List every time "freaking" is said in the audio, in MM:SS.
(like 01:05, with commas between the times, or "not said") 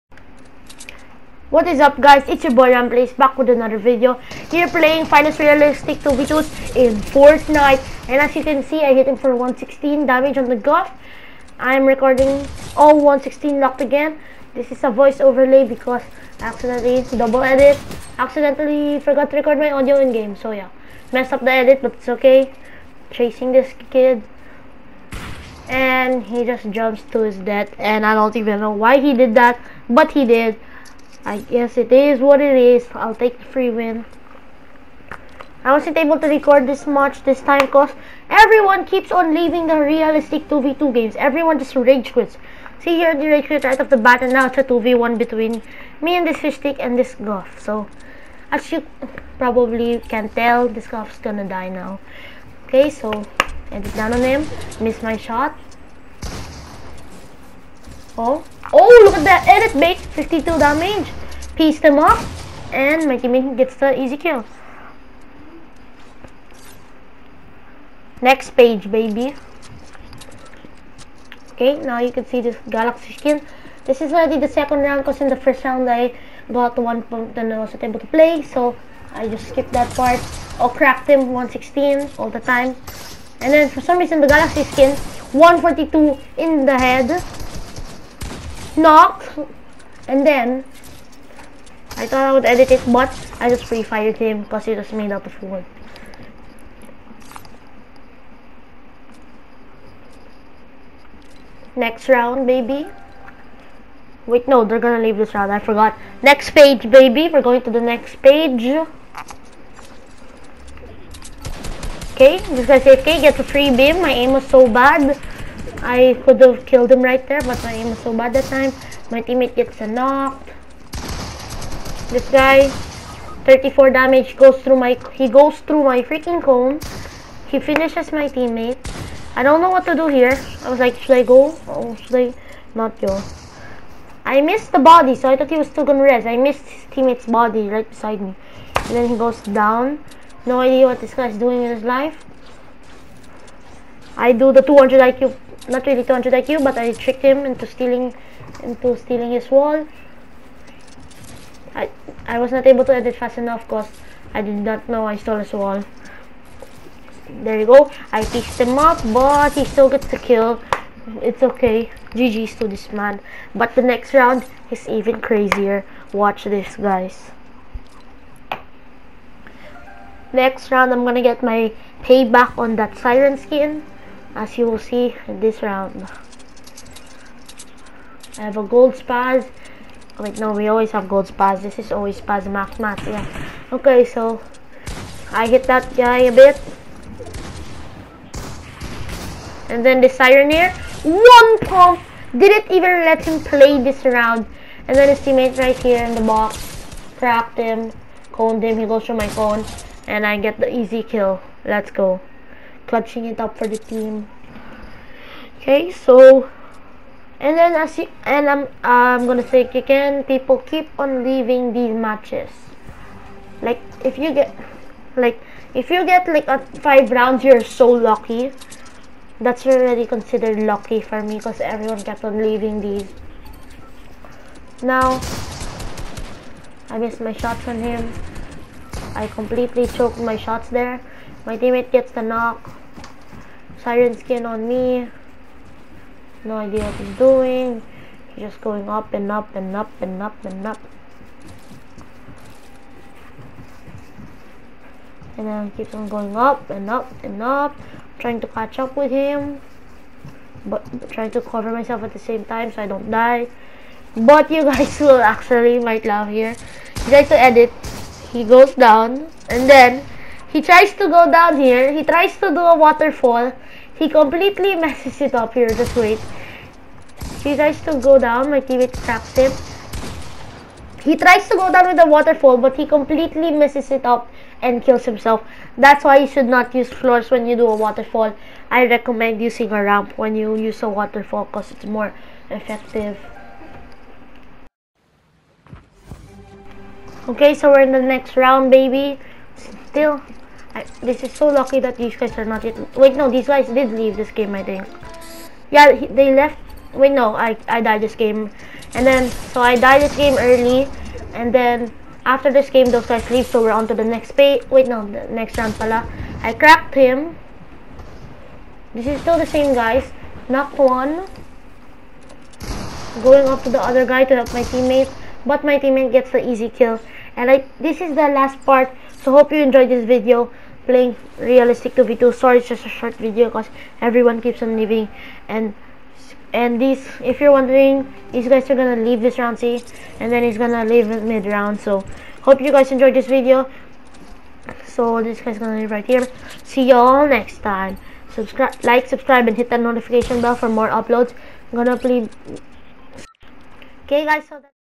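02:06.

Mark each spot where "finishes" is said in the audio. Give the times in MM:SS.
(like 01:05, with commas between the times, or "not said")
02:07.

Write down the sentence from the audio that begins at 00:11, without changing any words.
I'm recording all 116 locked again.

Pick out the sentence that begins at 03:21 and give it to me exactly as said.
Let's go clutching it up for the team.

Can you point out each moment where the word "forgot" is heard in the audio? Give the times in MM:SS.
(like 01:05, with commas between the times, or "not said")
00:19, 01:45.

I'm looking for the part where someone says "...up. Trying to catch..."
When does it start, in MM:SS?
04:07.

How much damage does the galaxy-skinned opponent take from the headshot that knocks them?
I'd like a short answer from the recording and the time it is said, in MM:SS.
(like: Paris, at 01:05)
142, at 01:25.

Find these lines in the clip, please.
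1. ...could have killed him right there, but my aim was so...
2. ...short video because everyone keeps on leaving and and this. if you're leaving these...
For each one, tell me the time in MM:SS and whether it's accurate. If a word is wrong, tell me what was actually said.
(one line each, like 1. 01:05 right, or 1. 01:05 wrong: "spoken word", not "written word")
1. 01:56 right
2. 05:22 wrong: "wondering", not "leaving".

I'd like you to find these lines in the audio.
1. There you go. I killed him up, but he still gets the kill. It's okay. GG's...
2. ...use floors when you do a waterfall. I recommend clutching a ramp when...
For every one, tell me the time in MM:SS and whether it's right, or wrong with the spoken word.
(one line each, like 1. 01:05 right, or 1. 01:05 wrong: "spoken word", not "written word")
1. 02:37 wrong: "pieced", not "killed"
2. 04:36 wrong: "using", not "clutching".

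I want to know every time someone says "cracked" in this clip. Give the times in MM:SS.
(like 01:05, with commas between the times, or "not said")
01:20, 05:06.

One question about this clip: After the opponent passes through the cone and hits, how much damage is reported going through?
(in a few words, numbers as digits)
34.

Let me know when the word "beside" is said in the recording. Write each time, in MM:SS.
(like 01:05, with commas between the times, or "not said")
02:17.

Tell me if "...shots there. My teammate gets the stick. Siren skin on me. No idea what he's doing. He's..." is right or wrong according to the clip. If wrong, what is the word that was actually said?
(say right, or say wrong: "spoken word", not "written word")
wrong: "knock", not "stick".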